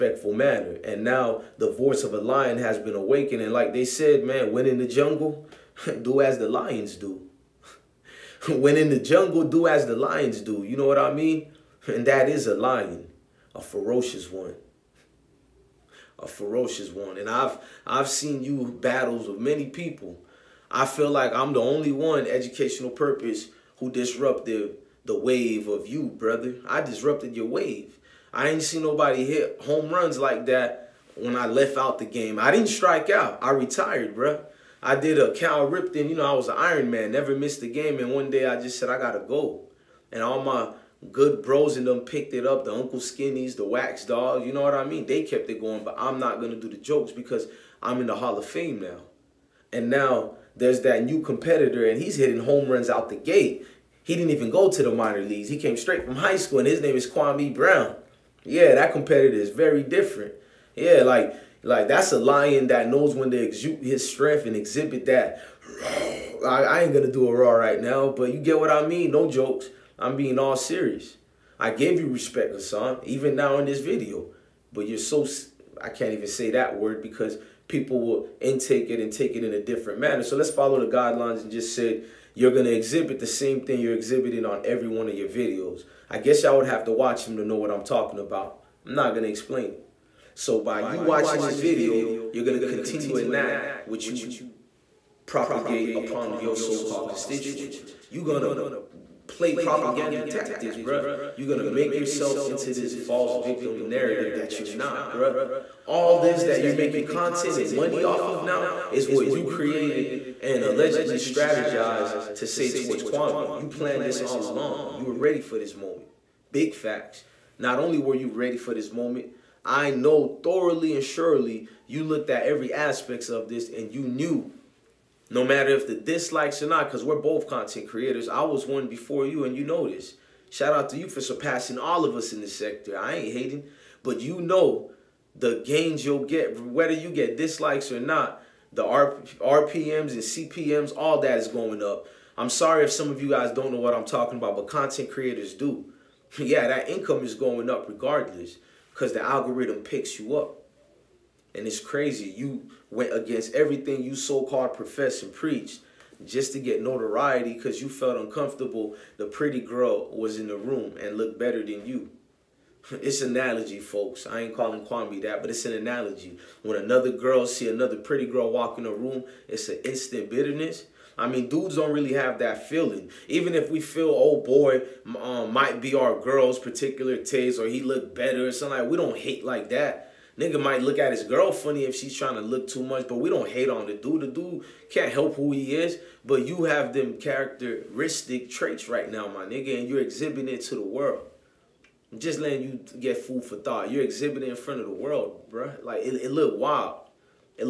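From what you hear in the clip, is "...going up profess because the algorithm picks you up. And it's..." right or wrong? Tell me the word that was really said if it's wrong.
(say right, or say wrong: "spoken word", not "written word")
wrong: "regardless", not "profess".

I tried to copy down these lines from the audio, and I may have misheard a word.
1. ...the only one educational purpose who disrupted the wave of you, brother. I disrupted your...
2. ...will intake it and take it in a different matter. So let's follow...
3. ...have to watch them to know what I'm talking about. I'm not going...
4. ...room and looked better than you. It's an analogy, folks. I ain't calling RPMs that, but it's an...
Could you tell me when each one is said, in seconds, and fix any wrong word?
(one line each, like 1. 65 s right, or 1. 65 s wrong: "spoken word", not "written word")
1. 21 s right
2. 78 s wrong: "manner", not "matter"
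3. 86 s right
4. 160 s wrong: "Kwame", not "RPMs".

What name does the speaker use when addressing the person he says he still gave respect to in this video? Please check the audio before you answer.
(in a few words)
Hassan.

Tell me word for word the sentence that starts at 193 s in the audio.
You're exhibiting in front of the world, bruh.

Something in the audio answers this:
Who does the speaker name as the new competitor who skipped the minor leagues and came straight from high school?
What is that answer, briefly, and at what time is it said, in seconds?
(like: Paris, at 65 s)
Kwame Brown, at 57 s.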